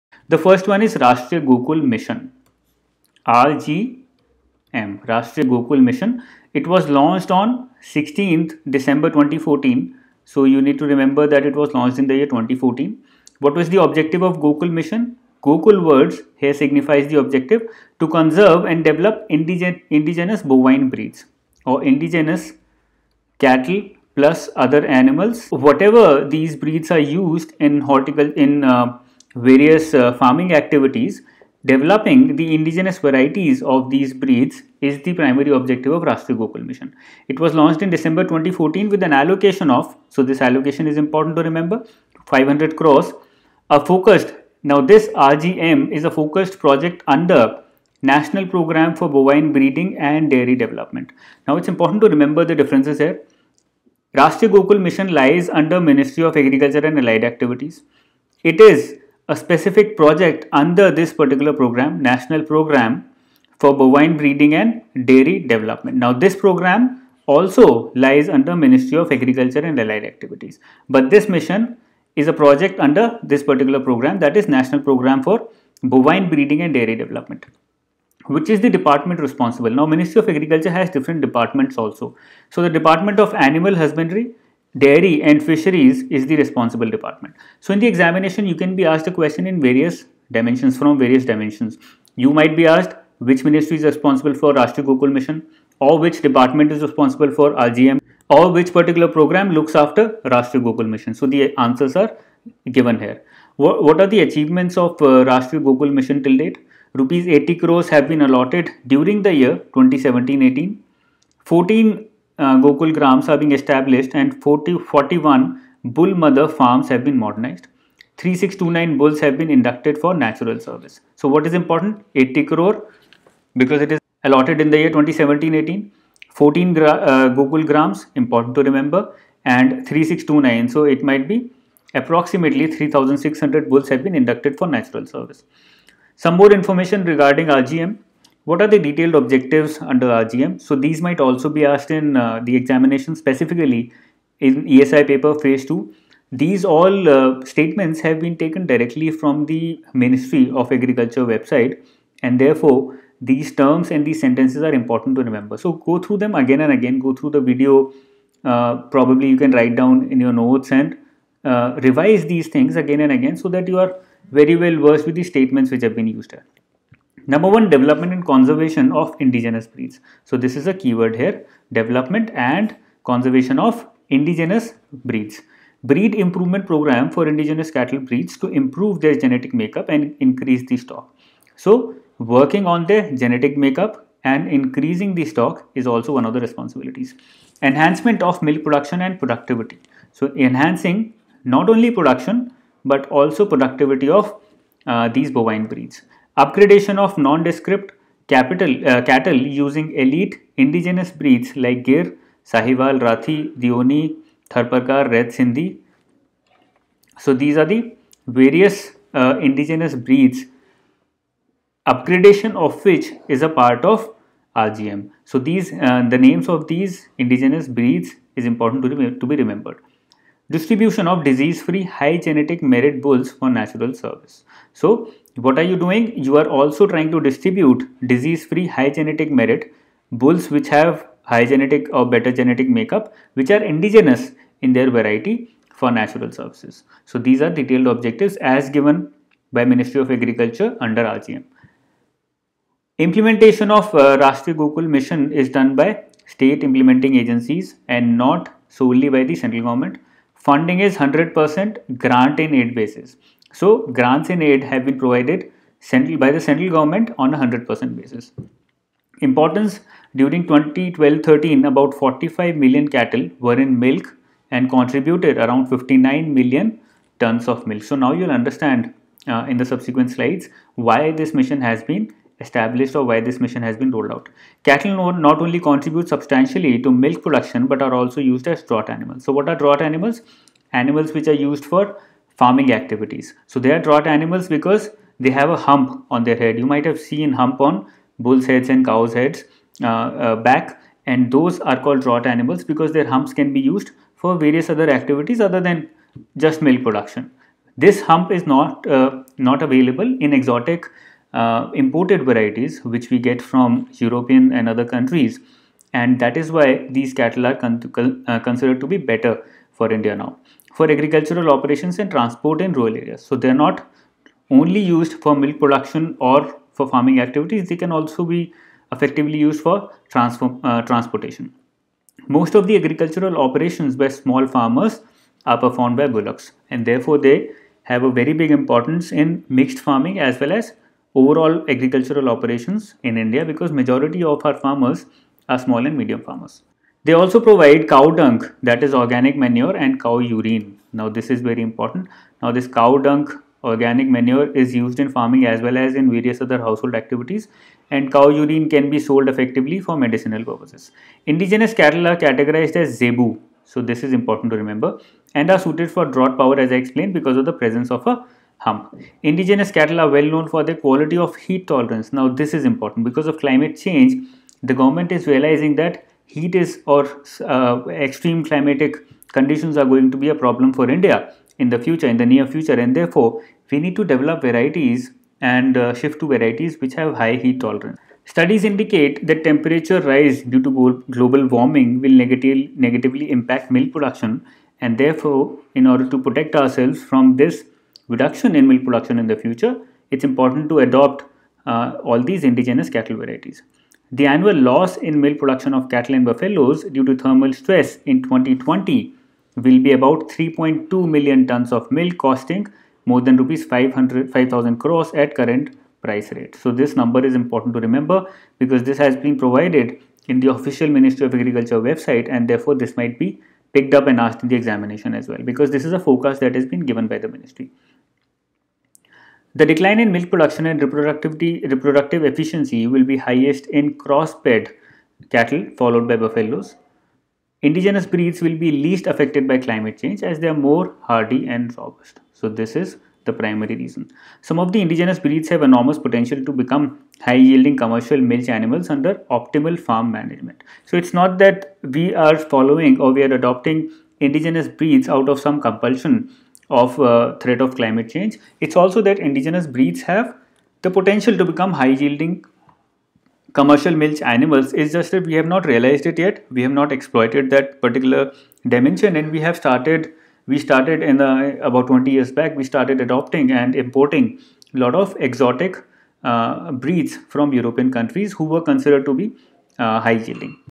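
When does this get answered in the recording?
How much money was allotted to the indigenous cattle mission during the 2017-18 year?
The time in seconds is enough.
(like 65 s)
106 s.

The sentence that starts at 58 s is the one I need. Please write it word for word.
It is a specific project under this particular program, National Program for Bovine Breeding and Dairy Development.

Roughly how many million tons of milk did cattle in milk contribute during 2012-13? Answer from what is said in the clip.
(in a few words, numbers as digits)
59 million tons.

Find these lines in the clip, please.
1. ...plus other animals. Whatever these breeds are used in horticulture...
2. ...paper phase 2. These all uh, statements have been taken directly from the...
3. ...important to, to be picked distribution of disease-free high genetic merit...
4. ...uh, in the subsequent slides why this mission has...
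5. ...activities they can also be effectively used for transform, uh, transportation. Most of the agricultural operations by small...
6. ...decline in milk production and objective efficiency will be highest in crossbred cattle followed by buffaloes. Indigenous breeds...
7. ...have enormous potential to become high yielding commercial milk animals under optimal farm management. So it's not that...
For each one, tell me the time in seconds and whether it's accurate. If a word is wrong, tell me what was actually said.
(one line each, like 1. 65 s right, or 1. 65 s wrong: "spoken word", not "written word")
1. 24 s right
2. 145 s right
3. 218 s wrong: "remembered", not "picked"
4. 269 s right
5. 317 s right
6. 419 s wrong: "reproductive", not "objective"
7. 435 s right.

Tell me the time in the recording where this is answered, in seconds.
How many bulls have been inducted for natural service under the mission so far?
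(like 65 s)
118 s.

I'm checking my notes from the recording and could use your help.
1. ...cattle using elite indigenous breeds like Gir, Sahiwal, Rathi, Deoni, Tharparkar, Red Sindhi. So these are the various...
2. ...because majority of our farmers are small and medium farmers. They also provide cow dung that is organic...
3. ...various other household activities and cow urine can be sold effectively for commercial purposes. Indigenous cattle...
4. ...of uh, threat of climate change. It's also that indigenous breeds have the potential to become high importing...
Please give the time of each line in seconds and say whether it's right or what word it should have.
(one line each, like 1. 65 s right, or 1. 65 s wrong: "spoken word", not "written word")
1. 199 s right
2. 333 s right
3. 346 s wrong: "medicinal", not "commercial"
4. 446 s wrong: "yielding", not "importing".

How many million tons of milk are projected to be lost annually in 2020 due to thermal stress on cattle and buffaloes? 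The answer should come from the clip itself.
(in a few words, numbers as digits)
3.2 million tons.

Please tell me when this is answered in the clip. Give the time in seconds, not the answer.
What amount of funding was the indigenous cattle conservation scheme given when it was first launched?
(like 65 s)
42 s.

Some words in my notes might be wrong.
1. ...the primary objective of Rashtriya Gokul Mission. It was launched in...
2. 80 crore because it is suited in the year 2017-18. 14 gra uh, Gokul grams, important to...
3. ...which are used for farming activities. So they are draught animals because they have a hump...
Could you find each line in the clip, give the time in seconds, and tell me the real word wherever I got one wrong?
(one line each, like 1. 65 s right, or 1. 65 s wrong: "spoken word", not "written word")
1. 35 s right
2. 122 s wrong: "allotted", not "suited"
3. 281 s right.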